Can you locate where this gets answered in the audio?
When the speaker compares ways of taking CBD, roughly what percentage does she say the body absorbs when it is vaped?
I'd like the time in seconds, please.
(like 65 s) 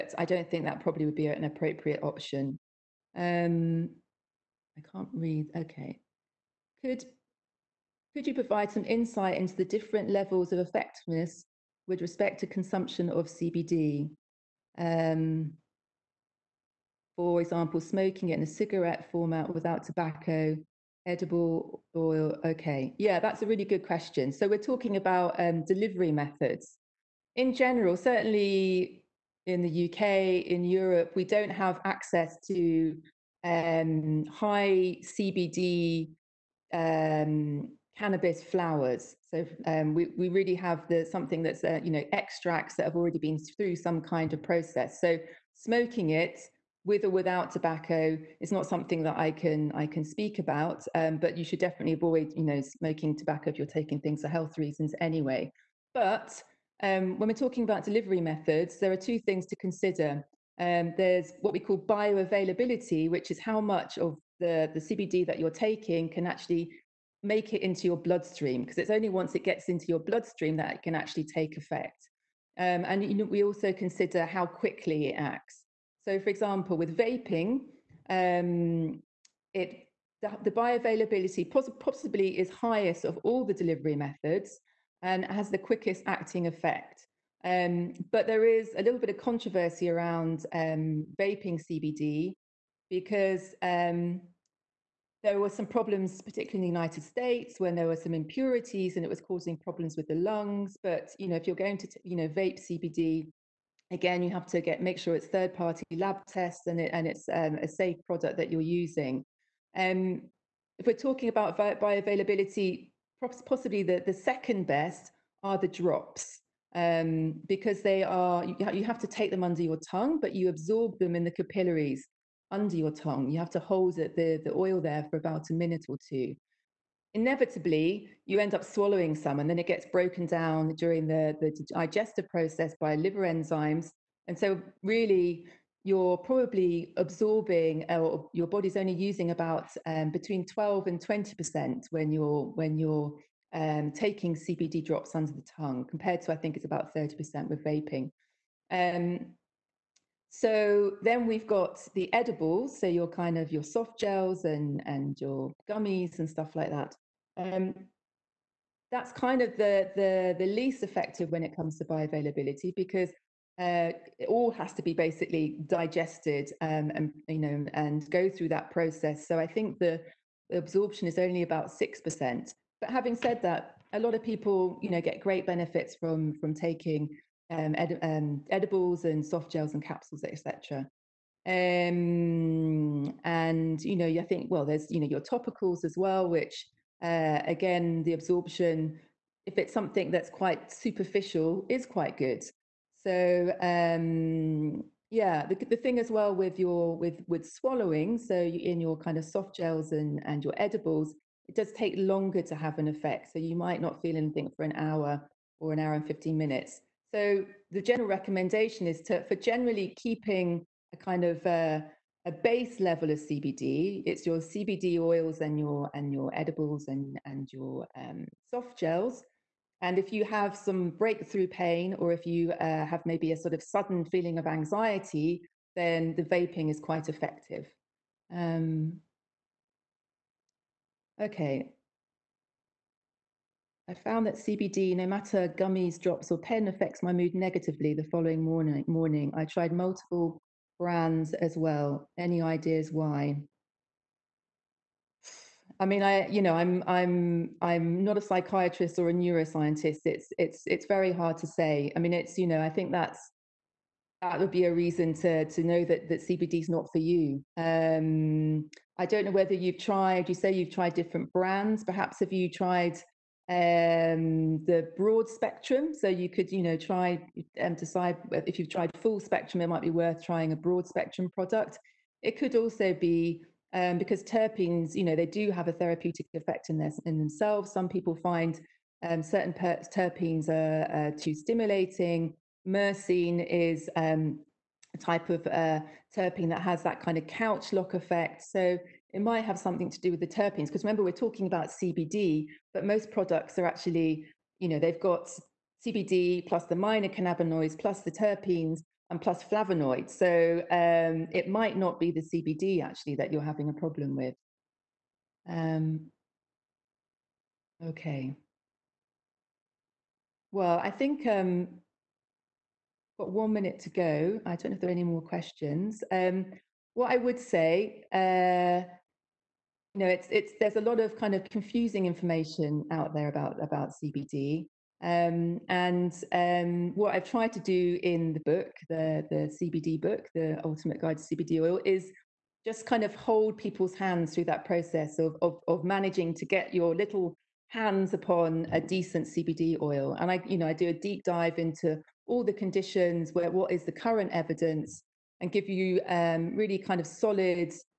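146 s.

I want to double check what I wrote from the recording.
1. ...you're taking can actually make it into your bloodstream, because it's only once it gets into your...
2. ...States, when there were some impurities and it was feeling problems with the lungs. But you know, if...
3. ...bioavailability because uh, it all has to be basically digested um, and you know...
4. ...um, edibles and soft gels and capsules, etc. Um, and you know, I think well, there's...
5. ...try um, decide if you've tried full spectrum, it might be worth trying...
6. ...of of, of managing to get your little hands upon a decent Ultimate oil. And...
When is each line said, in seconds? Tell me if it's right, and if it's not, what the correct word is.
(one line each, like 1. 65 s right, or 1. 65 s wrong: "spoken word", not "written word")
1. 65 s right
2. 97 s wrong: "causing", not "feeling"
3. 161 s right
4. 178 s right
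5. 266 s right
6. 335 s wrong: "CBD", not "Ultimate".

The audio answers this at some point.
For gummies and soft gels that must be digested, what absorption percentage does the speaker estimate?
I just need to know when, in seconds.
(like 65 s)
171 s.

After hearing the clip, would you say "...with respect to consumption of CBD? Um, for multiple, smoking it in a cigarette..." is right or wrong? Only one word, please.
wrong.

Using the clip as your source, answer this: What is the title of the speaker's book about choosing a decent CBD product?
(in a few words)
The Ultimate Guide to CBD Oil.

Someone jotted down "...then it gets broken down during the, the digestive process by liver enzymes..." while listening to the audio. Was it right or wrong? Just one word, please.
right.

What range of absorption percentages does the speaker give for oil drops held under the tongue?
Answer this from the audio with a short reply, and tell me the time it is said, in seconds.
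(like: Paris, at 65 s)
12 to 20%, at 140 s.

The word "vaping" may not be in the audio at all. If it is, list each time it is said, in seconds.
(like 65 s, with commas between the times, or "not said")
76 s, 91 s, 147 s, 226 s.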